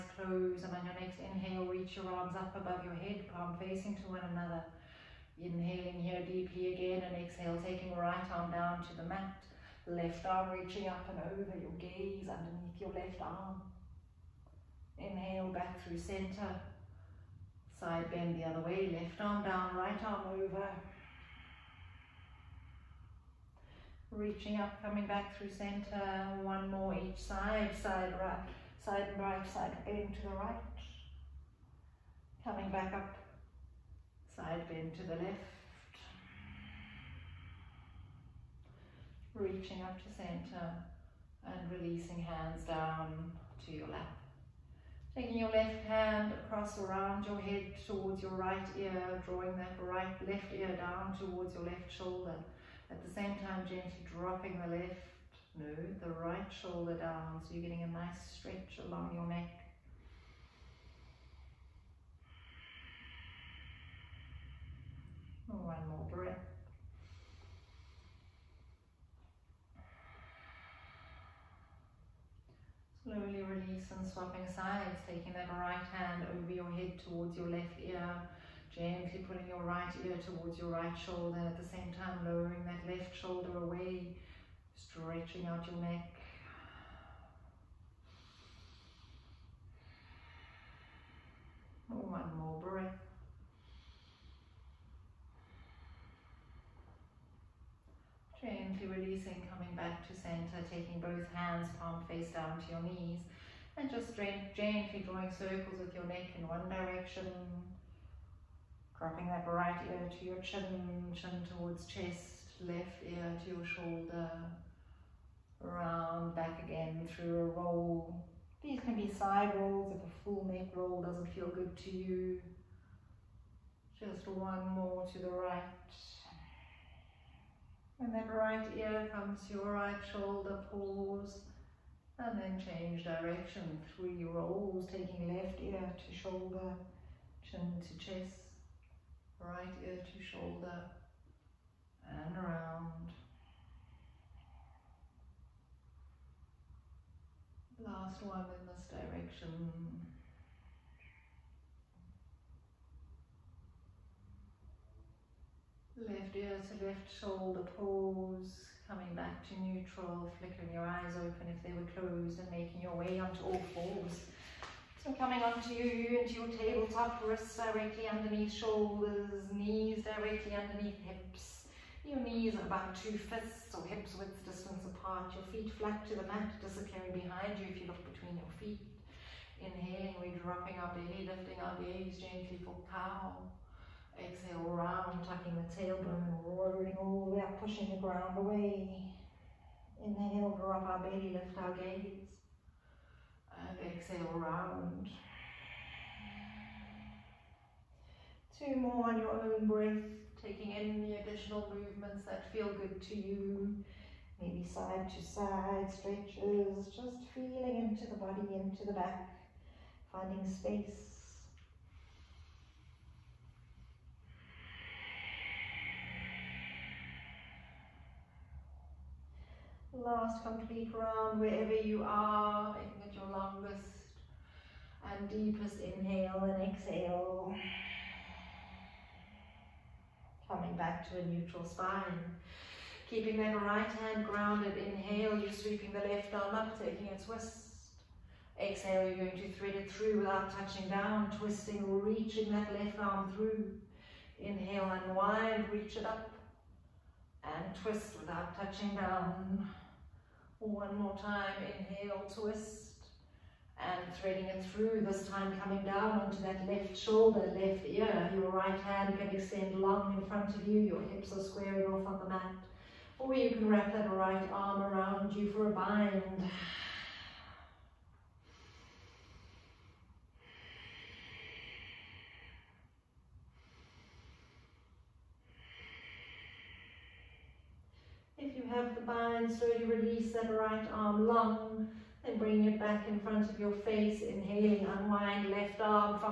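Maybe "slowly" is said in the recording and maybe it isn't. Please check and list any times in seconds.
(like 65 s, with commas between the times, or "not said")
73 s, 279 s.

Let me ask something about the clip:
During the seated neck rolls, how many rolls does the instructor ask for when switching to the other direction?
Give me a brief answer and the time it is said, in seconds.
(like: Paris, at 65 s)
3, at 133 s.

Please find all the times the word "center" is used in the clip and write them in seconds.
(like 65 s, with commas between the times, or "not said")
15 s, 25 s, 40 s, 100 s.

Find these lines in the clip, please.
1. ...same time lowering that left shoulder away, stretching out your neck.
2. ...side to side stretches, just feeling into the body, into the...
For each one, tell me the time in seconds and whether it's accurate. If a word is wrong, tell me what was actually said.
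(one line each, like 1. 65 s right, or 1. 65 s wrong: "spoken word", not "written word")
1. 81 s right
2. 204 s right.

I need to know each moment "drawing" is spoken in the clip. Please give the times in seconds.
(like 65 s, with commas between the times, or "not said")
49 s, 105 s.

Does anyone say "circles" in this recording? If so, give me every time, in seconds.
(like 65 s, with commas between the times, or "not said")
105 s.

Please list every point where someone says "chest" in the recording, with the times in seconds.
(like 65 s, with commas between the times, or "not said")
111 s, 138 s.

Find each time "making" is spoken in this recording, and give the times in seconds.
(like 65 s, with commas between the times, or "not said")
162 s, 222 s.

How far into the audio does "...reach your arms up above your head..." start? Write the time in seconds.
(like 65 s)
1 s.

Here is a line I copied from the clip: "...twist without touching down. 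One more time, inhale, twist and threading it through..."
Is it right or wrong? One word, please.
right.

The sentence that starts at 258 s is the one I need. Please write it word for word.
Your right hand can extend long in front of you, your hips are squaring off on the mat.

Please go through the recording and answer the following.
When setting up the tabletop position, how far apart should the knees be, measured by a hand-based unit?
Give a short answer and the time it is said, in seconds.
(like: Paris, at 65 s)
2 fists, at 172 s.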